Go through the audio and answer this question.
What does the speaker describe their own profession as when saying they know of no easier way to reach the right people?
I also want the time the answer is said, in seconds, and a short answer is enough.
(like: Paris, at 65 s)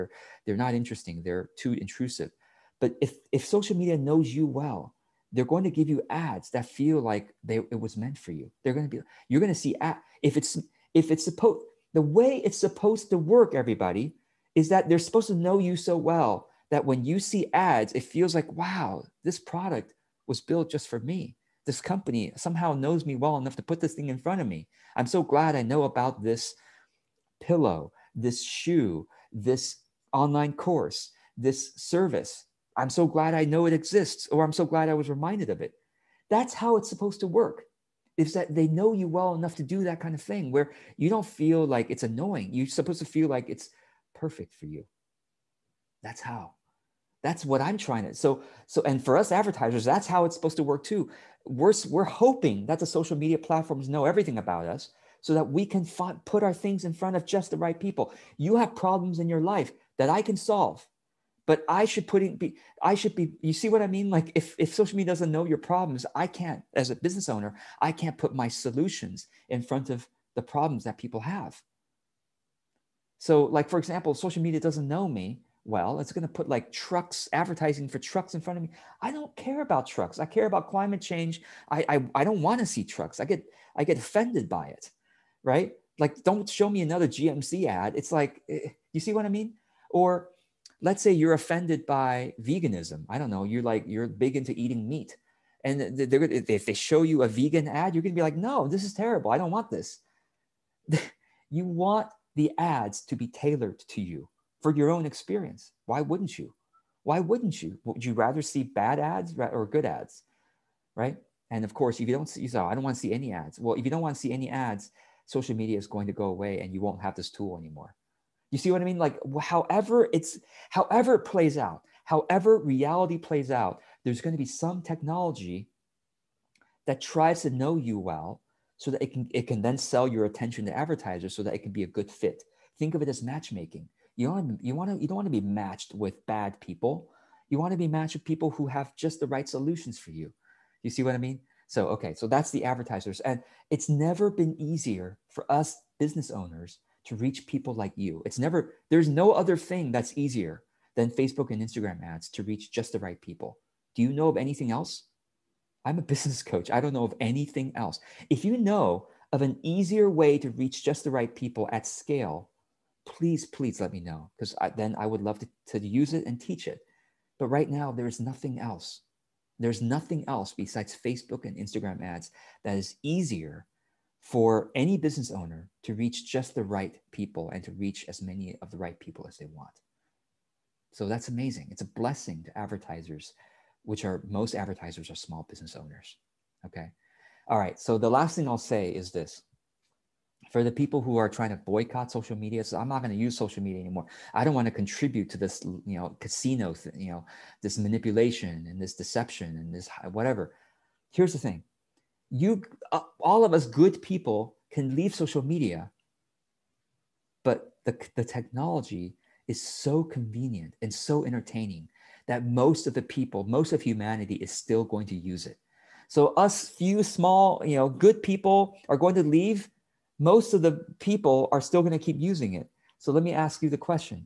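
Business coach, at 156 s.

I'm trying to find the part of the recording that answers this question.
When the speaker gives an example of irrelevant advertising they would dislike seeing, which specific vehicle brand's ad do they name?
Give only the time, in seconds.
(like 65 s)
87 s.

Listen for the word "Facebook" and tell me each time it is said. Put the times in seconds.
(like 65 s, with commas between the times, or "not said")
151 s, 171 s.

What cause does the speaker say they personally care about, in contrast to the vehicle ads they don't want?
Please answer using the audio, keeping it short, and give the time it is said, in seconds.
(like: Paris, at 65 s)
Climate change, at 80 s.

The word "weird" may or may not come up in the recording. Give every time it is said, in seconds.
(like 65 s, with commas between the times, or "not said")
not said.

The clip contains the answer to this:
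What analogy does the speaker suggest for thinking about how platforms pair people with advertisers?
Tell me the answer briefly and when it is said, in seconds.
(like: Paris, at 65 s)
Matchmaking, at 133 s.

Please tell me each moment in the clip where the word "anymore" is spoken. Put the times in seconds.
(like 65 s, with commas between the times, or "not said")
117 s, 193 s.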